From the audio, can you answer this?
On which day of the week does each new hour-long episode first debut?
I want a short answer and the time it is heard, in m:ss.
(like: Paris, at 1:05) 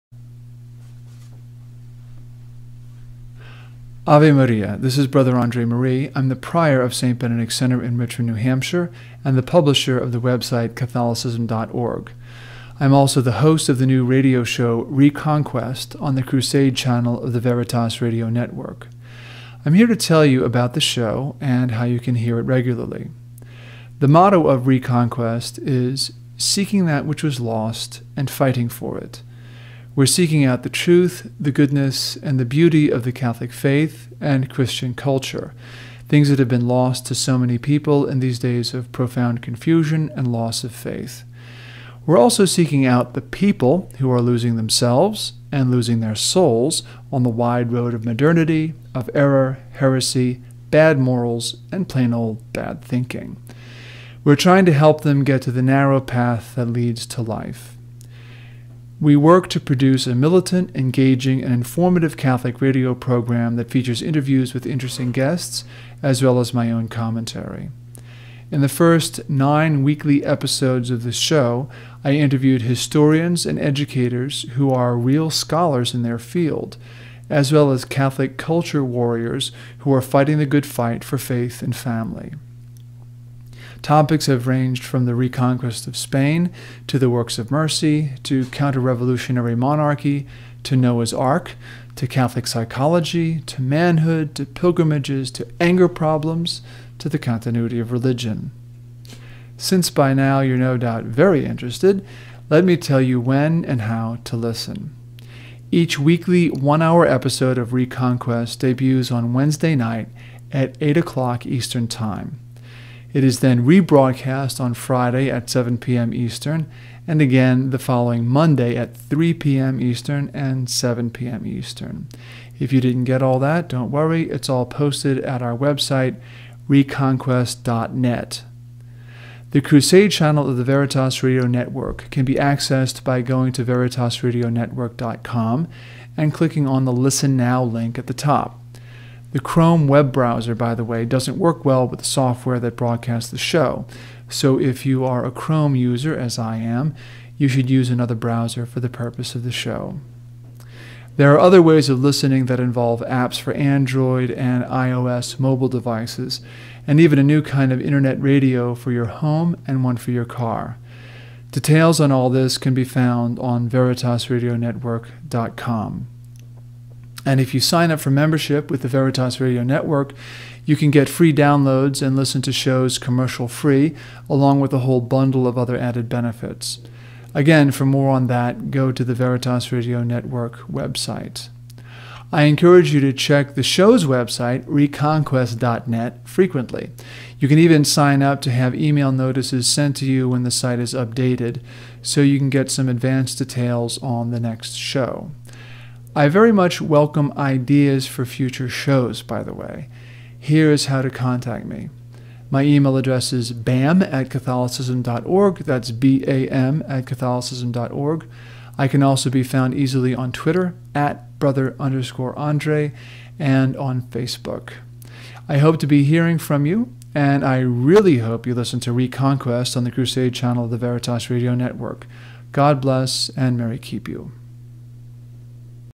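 Wednesday, at 1:49.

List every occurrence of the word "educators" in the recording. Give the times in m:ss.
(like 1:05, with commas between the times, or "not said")
1:13.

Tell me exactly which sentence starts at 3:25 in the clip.
That's B A M at catholicism.org.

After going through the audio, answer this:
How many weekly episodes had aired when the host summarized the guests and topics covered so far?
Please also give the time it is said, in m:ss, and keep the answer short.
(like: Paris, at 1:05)
9, at 1:09.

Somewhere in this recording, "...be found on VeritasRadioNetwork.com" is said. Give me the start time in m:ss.
2:42.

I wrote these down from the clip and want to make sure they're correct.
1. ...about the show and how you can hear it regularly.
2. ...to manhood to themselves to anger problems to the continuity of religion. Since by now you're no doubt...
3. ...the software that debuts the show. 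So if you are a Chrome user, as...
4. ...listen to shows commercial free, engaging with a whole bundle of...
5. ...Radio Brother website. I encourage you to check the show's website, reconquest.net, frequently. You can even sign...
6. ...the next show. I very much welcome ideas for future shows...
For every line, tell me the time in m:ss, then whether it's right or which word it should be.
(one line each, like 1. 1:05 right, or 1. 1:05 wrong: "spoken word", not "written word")
1. 0:20 right
2. 1:33 wrong: "pilgrimages", not "themselves"
3. 2:21 wrong: "broadcasts", not "debuts"
4. 2:52 wrong: "along", not "engaging"
5. 2:59 wrong: "Network", not "Brother"
6. 3:14 right.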